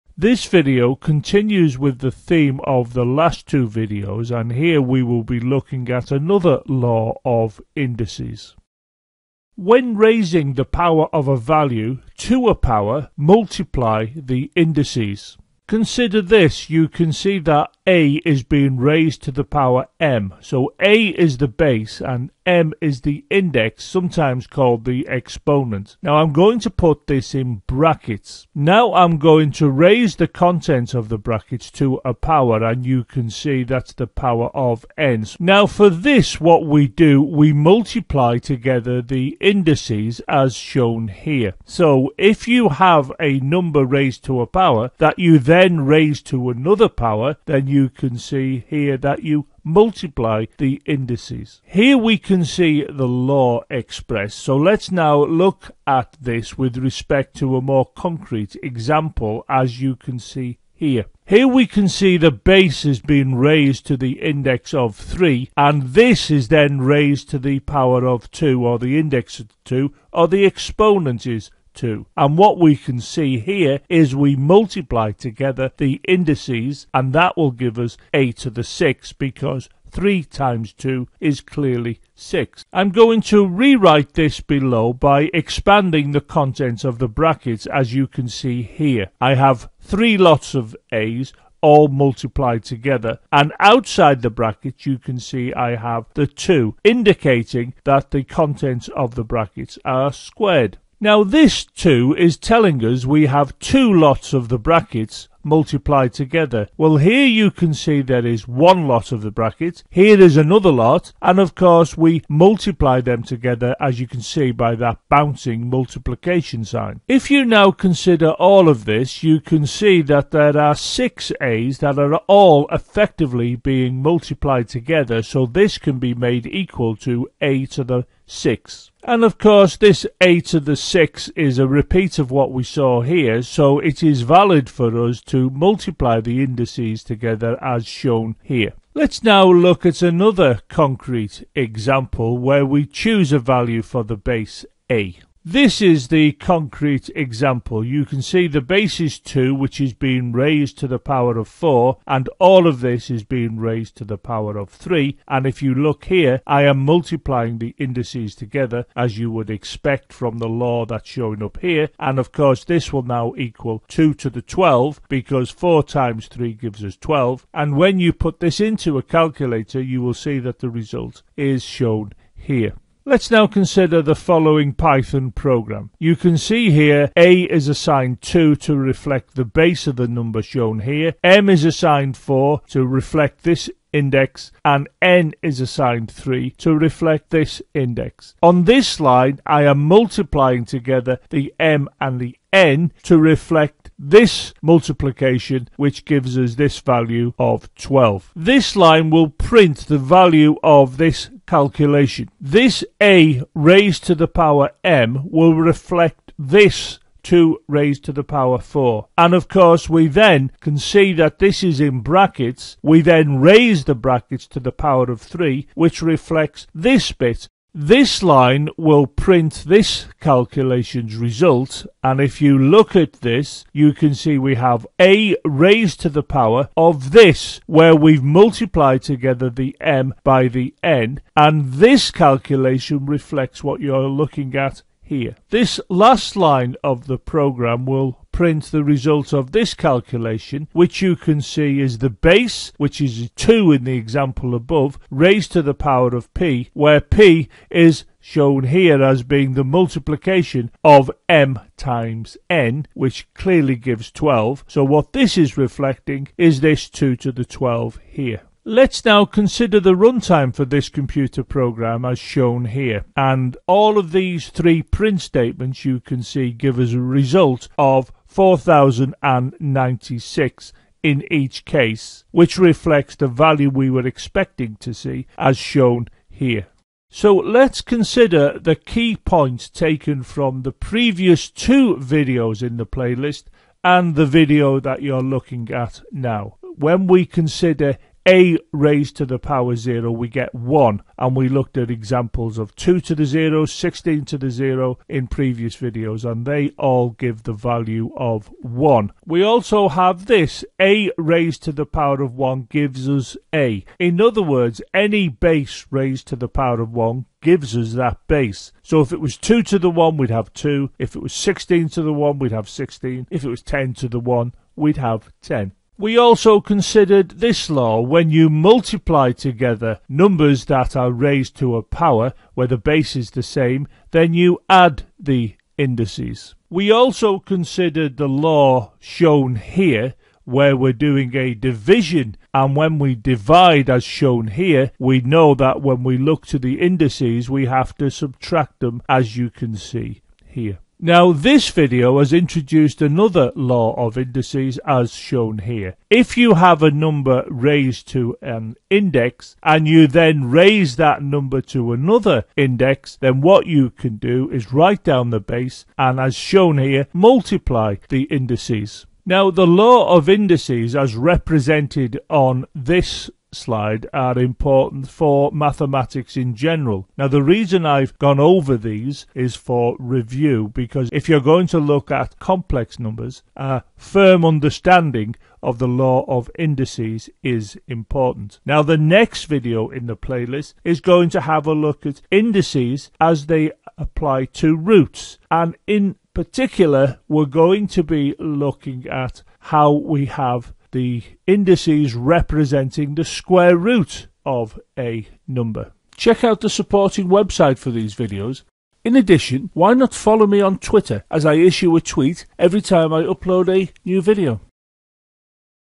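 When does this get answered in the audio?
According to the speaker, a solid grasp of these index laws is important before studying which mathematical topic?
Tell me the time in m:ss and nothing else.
6:12.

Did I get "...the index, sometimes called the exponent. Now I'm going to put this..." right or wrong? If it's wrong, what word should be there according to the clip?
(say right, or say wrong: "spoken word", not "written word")
right.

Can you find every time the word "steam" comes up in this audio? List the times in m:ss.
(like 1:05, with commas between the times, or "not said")
not said.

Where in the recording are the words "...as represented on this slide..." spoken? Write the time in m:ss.
6:00.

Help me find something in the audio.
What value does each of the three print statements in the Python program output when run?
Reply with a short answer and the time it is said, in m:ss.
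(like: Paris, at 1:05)
4096, at 4:28.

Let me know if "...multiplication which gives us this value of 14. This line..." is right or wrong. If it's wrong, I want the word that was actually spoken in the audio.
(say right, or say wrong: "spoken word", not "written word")
wrong: "12", not "14".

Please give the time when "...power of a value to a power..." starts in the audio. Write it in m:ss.
0:10.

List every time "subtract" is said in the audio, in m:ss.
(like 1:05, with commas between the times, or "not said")
5:38.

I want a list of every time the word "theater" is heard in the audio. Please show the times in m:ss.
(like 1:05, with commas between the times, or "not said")
not said.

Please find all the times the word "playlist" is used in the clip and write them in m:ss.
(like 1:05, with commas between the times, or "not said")
4:42, 6:20.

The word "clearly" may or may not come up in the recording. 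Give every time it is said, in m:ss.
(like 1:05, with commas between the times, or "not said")
1:21, 4:13.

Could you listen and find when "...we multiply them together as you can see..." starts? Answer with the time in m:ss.
1:51.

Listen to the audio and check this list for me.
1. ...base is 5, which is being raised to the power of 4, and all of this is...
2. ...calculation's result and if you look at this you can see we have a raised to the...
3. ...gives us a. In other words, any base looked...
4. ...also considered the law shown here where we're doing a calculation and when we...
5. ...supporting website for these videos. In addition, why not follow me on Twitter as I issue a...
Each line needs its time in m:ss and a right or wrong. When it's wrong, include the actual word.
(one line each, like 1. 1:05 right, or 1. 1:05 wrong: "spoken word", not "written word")
1. 2:28 wrong: "2", not "5"
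2. 3:40 right
3. 5:02 wrong: "raised", not "looked"
4. 5:26 wrong: "division", not "calculation"
5. 6:36 right.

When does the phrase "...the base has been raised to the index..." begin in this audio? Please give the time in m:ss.
1:02.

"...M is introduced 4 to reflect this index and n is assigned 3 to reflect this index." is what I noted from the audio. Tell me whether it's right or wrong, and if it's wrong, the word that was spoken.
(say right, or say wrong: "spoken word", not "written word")
wrong: "assigned", not "introduced".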